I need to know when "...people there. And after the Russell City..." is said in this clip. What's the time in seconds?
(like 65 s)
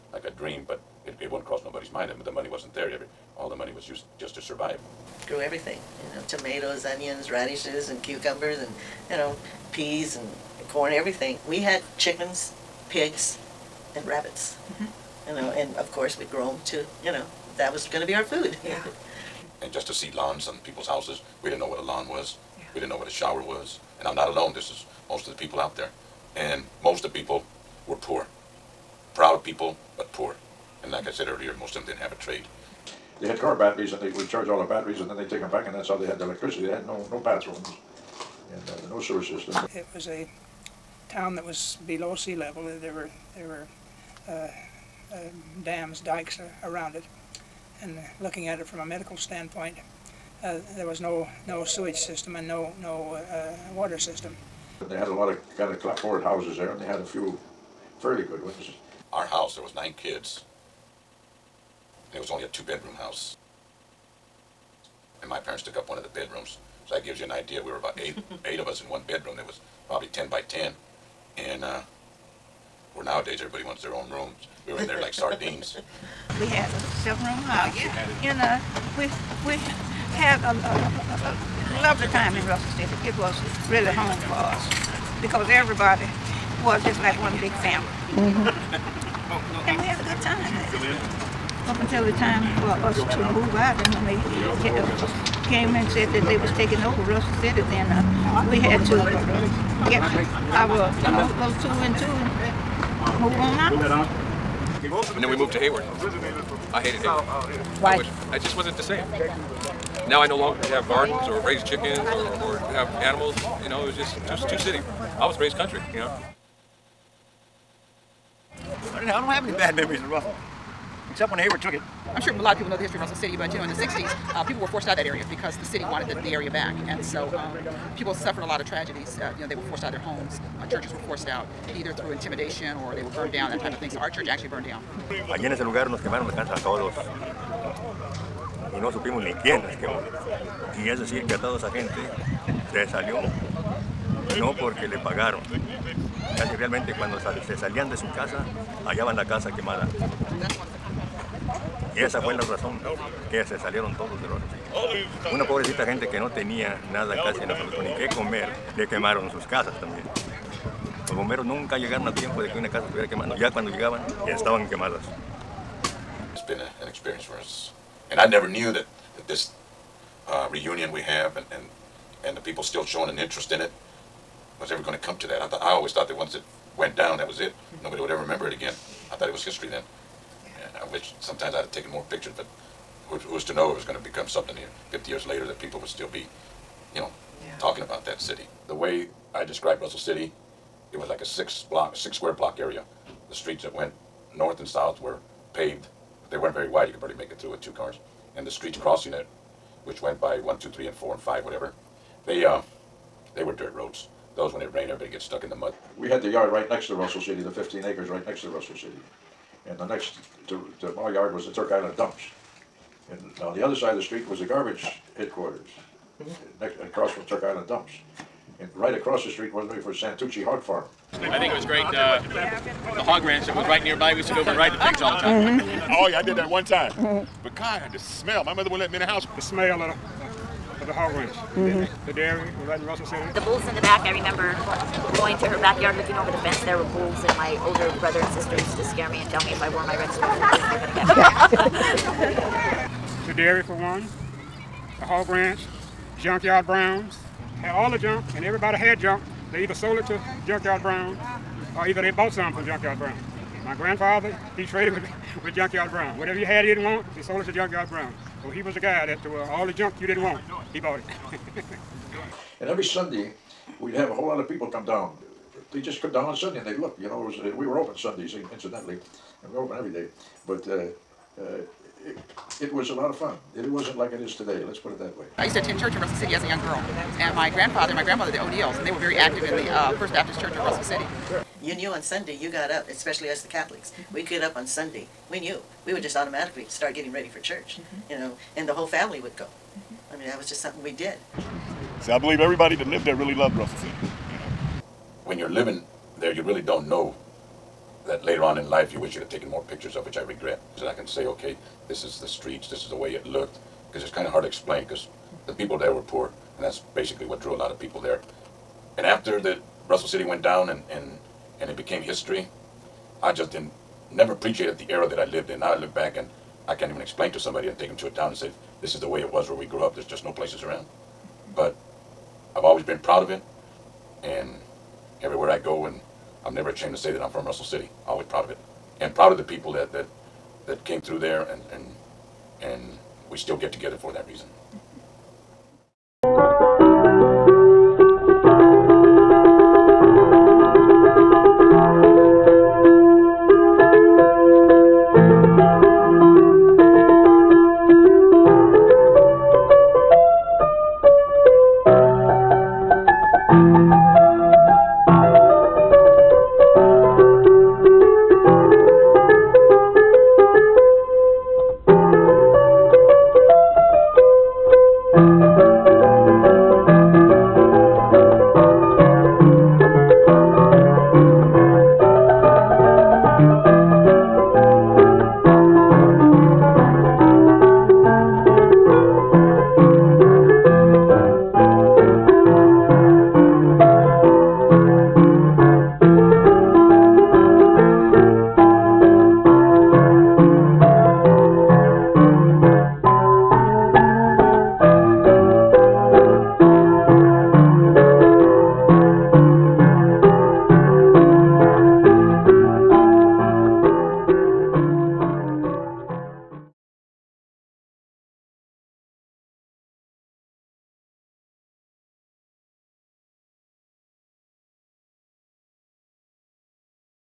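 307 s.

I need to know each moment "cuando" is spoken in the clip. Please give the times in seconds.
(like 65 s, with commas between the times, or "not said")
146 s, 163 s.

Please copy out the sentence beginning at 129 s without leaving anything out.
Uh, you know, they were forced out of their homes.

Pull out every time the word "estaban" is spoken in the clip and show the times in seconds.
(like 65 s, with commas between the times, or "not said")
164 s.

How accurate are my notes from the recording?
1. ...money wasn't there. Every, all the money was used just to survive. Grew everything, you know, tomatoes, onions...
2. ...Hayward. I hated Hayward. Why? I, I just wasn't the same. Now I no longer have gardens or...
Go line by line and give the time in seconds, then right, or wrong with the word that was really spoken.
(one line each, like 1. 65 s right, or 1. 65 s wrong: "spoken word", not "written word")
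1. 2 s right
2. 105 s right.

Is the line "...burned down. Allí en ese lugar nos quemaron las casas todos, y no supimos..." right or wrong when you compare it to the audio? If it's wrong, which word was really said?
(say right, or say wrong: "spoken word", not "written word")
right.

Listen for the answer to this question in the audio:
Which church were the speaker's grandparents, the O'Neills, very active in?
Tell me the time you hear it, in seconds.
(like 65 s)
279 s.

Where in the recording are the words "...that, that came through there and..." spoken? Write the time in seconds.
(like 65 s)
329 s.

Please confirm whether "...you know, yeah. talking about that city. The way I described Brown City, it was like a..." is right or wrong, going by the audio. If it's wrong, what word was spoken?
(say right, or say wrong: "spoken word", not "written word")
wrong: "Russell", not "Brown".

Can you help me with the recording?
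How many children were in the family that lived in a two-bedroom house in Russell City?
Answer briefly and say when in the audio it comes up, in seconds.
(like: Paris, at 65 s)
9, at 59 s.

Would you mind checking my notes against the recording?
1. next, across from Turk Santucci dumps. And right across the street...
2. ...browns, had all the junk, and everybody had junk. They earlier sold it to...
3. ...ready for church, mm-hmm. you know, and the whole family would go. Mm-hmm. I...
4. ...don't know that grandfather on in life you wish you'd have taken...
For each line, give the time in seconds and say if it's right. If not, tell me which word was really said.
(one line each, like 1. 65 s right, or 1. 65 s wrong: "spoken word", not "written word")
1. 216 s wrong: "Island", not "Santucci"
2. 246 s wrong: "either", not "earlier"
3. 287 s right
4. 296 s wrong: "later", not "grandfather".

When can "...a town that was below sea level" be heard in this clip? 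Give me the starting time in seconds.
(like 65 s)
40 s.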